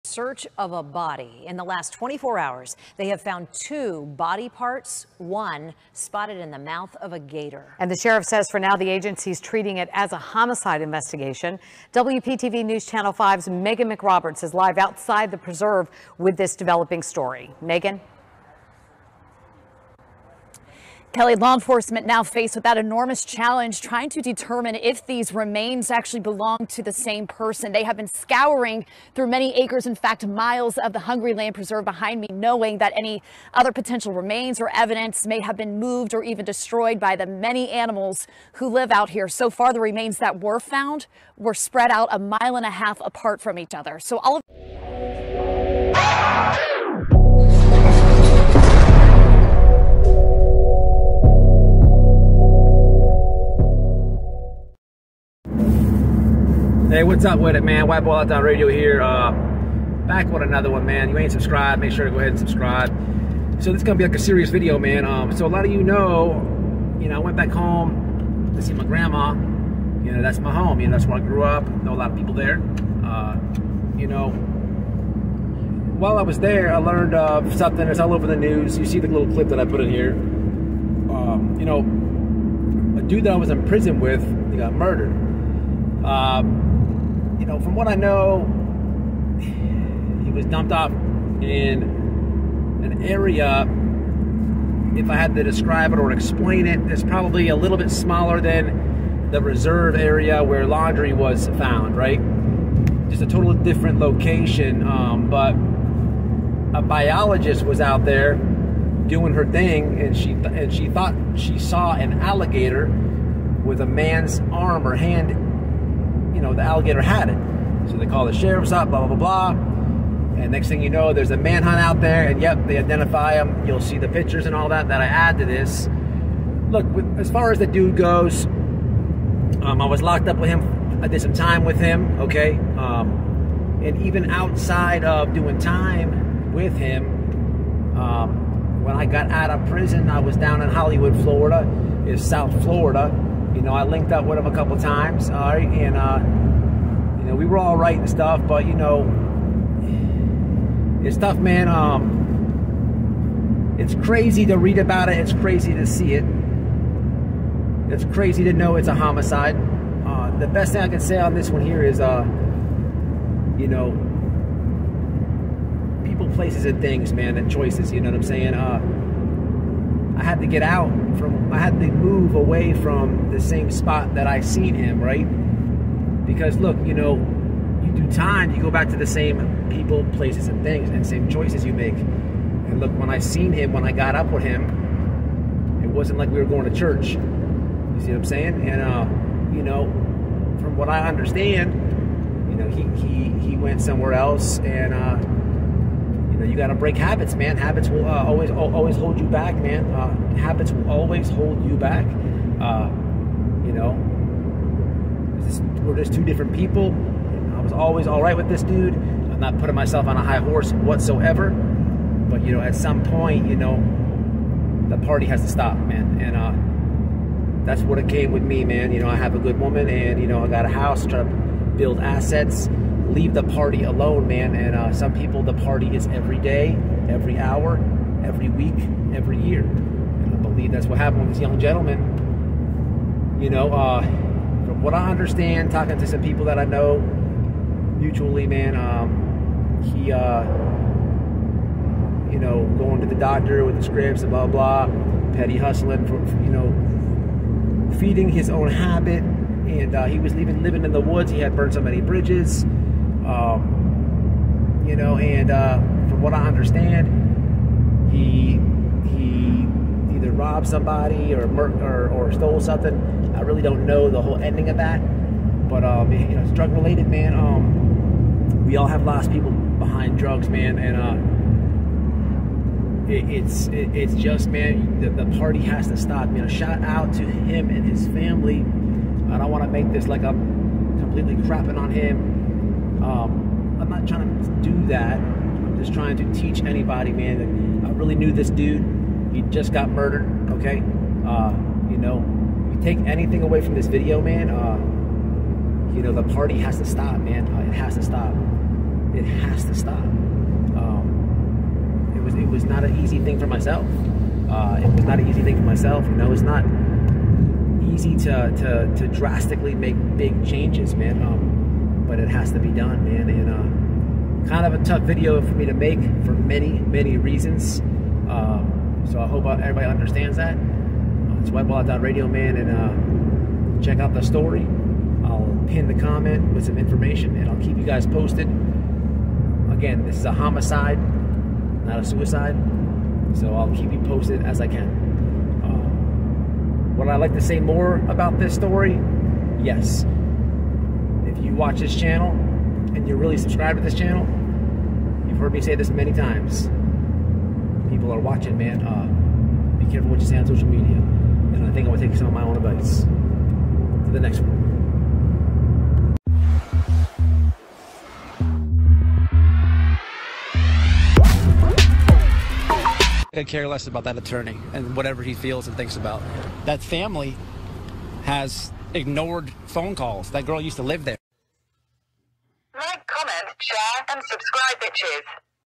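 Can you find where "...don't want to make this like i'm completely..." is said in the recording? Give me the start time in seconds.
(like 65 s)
279 s.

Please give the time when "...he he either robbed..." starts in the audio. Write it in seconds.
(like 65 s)
258 s.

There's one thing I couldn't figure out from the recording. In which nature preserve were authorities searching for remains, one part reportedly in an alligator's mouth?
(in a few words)
Hungryland Preserve.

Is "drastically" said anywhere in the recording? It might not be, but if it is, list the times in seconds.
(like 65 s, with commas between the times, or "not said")
309 s.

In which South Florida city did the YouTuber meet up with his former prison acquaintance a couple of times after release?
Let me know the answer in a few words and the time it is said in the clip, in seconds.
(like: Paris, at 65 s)
Hollywood, Florida, at 140 s.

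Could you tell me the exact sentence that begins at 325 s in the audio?
I'll pin the comment with some information, and I'll keep you guys posted.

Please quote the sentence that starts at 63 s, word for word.
So this is gonna be like a serious video, man.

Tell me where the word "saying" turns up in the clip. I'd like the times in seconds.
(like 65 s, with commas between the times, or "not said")
168 s, 188 s.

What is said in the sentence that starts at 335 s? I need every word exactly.
Um, would I like to say more about this story?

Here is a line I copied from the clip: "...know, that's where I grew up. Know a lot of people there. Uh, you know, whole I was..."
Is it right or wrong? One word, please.
wrong.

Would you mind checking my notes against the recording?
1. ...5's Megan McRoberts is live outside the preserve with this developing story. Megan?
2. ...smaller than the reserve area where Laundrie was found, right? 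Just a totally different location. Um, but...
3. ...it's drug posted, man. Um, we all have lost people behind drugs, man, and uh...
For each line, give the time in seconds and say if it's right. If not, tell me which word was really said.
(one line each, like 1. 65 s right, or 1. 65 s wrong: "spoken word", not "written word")
1. 13 s right
2. 97 s right
3. 266 s wrong: "related", not "posted".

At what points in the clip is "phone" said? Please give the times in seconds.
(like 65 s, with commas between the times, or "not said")
369 s.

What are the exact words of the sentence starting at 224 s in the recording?
And uh, some people, the party is every day, every hour, every week, every year.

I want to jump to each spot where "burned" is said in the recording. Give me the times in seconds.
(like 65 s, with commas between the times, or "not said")
251 s.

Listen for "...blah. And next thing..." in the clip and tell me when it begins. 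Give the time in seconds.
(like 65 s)
119 s.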